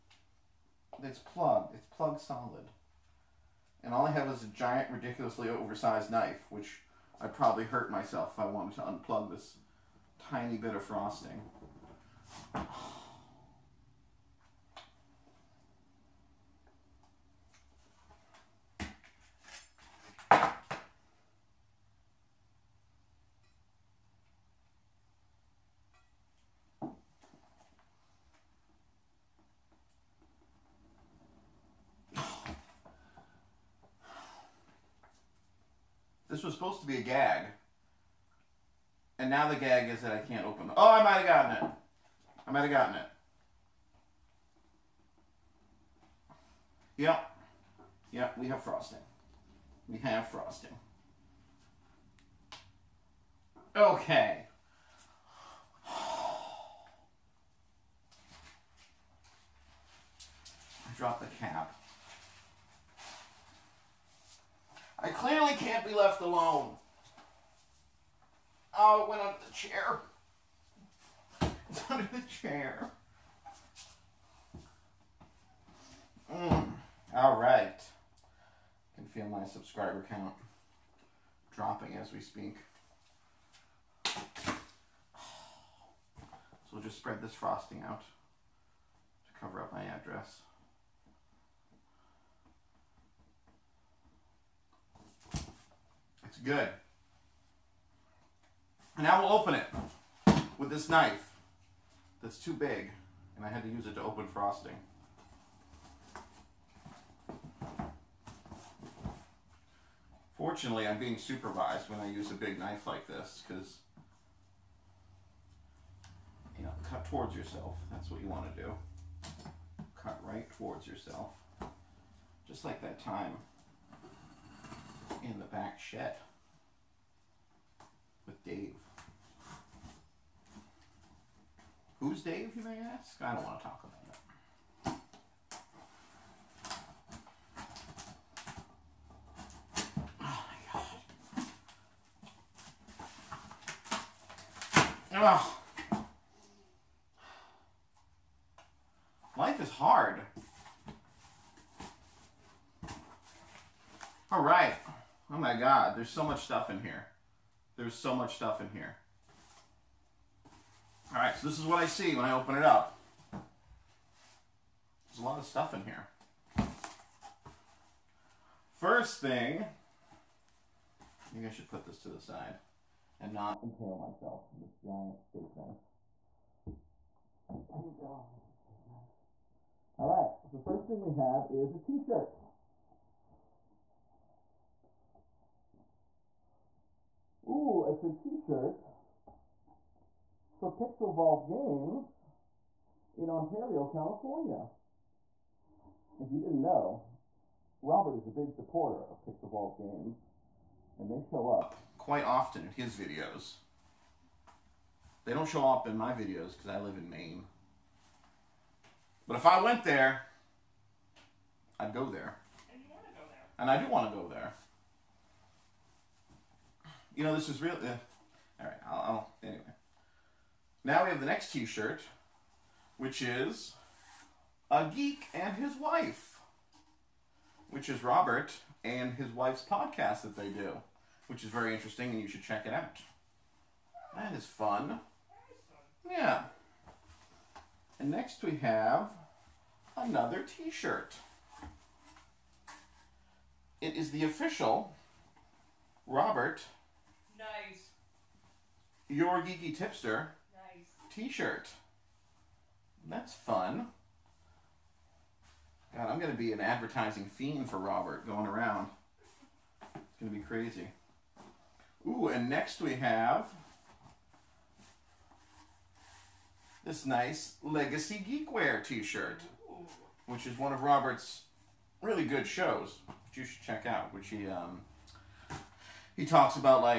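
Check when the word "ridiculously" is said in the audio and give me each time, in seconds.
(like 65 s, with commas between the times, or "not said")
4 s.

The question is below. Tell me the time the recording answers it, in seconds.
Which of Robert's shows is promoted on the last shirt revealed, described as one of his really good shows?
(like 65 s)
267 s.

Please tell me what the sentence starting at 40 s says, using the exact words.
Oh, I might have gotten it.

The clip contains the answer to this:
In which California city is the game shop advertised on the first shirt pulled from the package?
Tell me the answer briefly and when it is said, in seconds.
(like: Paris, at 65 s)
Ontario, at 193 s.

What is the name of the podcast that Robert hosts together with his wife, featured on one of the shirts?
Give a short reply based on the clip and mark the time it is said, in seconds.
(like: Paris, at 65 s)
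A Geek and His Wife, at 224 s.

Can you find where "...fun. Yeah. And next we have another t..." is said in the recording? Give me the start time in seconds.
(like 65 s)
234 s.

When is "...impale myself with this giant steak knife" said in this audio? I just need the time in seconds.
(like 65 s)
173 s.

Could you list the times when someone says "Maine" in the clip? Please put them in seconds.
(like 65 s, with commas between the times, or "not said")
207 s.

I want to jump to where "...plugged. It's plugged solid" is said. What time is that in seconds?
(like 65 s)
1 s.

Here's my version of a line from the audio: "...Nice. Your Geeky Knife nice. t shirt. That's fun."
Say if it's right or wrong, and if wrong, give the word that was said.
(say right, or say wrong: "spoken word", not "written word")
wrong: "Tipster", not "Knife".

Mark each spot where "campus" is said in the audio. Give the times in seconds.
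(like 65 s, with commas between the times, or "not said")
not said.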